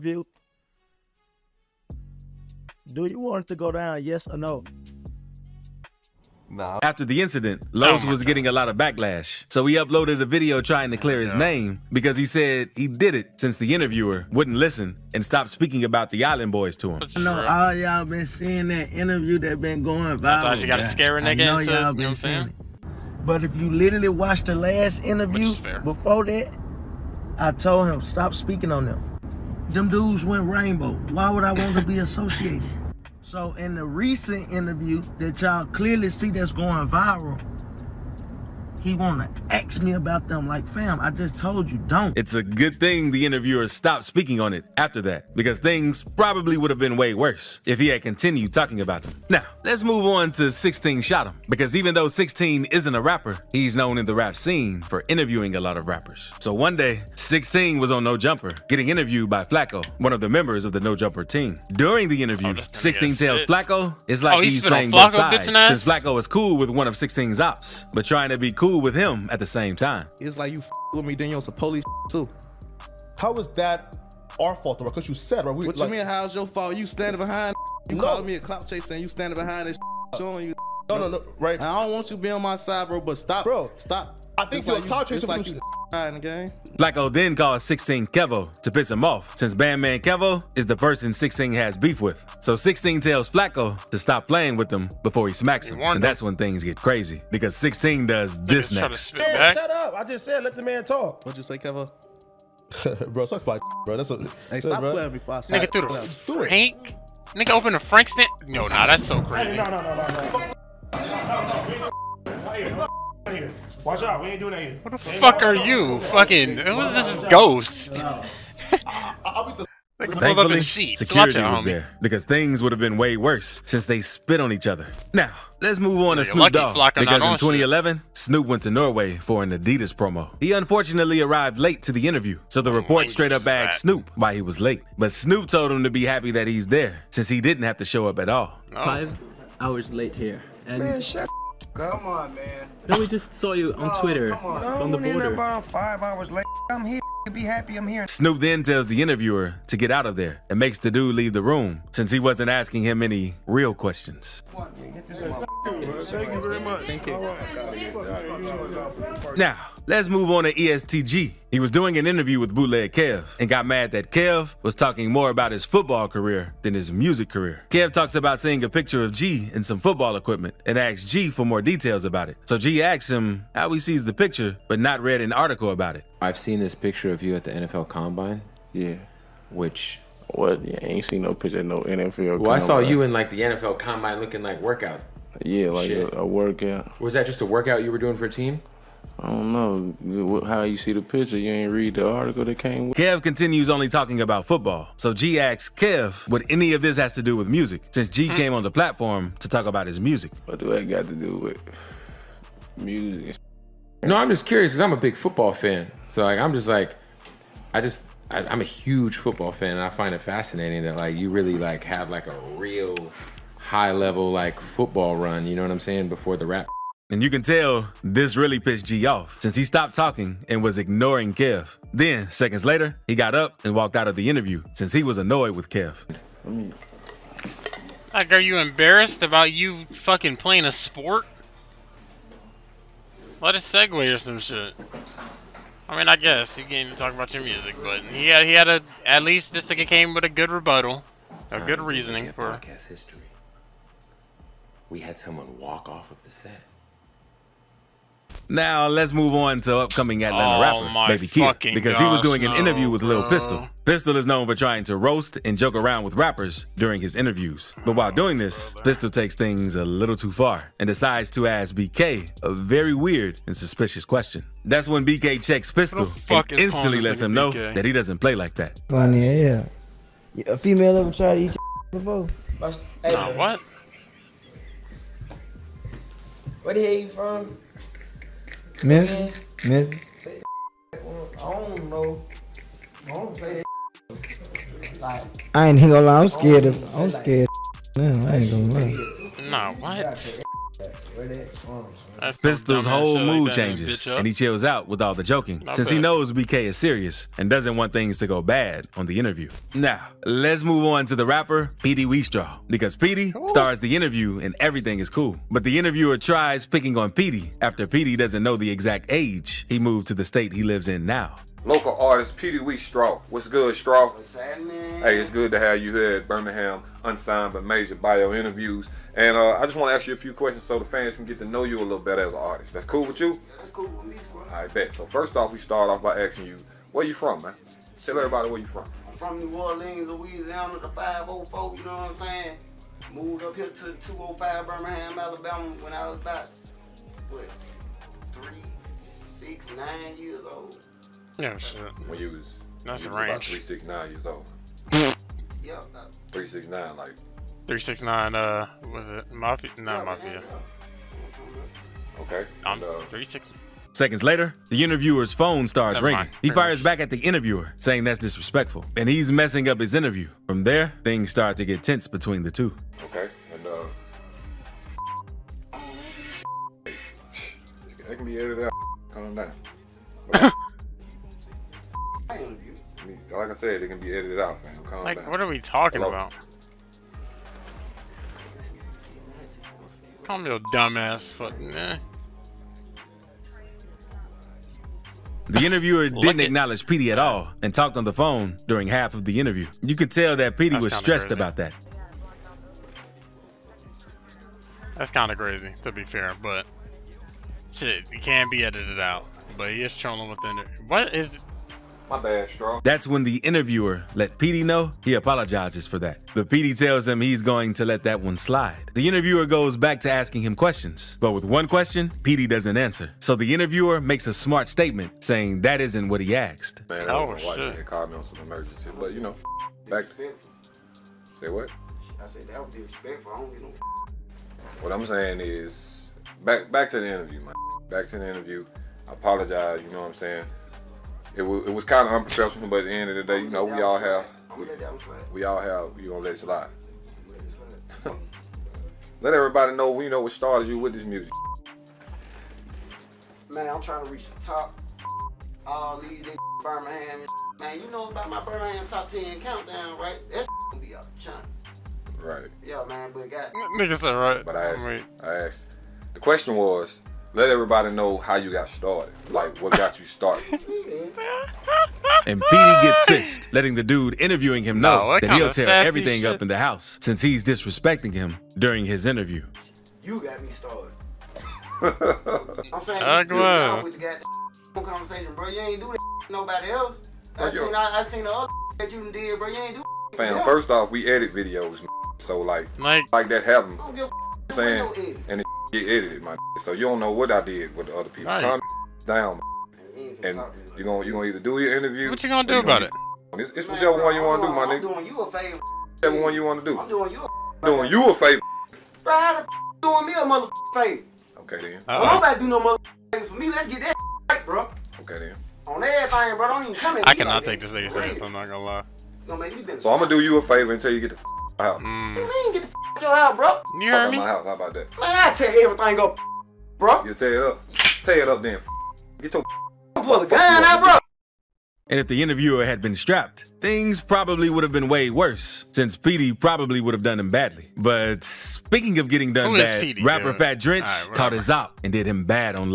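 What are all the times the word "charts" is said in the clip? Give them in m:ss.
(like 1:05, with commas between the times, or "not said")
not said.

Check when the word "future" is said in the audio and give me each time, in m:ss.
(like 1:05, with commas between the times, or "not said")
not said.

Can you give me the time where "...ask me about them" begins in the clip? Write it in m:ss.
0:39.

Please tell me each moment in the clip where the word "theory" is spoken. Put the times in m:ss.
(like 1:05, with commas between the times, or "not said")
not said.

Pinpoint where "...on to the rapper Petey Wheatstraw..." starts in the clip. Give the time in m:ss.
5:00.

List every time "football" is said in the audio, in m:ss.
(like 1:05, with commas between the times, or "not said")
2:45, 2:49, 3:14, 3:25, 3:29, 3:34.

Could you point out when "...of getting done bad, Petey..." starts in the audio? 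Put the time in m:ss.
8:48.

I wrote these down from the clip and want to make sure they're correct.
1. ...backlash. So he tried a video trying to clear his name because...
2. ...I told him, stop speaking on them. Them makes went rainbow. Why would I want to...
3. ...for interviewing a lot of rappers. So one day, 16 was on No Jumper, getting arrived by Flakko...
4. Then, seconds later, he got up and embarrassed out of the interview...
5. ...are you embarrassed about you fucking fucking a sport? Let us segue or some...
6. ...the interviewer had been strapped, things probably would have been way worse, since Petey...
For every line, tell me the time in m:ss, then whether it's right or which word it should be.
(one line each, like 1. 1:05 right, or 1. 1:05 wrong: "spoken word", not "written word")
1. 0:08 wrong: "uploaded", not "tried"
2. 0:27 wrong: "dudes", not "makes"
3. 0:54 wrong: "interviewed", not "arrived"
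4. 3:41 wrong: "walked", not "embarrassed"
5. 3:48 wrong: "playing", not "fucking"
6. 8:42 right.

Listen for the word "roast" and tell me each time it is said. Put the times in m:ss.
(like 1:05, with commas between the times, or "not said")
4:14.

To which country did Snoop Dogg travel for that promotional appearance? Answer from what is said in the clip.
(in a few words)
Norway.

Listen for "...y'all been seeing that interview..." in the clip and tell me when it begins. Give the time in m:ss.
0:17.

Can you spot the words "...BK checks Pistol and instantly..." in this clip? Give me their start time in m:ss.
4:25.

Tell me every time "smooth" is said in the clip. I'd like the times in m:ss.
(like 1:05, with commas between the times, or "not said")
not said.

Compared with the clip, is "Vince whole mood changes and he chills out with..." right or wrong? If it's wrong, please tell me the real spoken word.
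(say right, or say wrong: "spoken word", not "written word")
right.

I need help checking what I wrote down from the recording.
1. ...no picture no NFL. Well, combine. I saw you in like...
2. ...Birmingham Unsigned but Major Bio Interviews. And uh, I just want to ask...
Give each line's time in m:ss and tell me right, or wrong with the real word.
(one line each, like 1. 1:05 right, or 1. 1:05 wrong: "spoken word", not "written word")
1. 3:01 right
2. 5:16 right.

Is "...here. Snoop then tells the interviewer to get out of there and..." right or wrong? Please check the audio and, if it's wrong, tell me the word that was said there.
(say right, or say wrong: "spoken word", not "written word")
right.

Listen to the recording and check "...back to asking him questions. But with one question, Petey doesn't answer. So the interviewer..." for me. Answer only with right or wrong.
right.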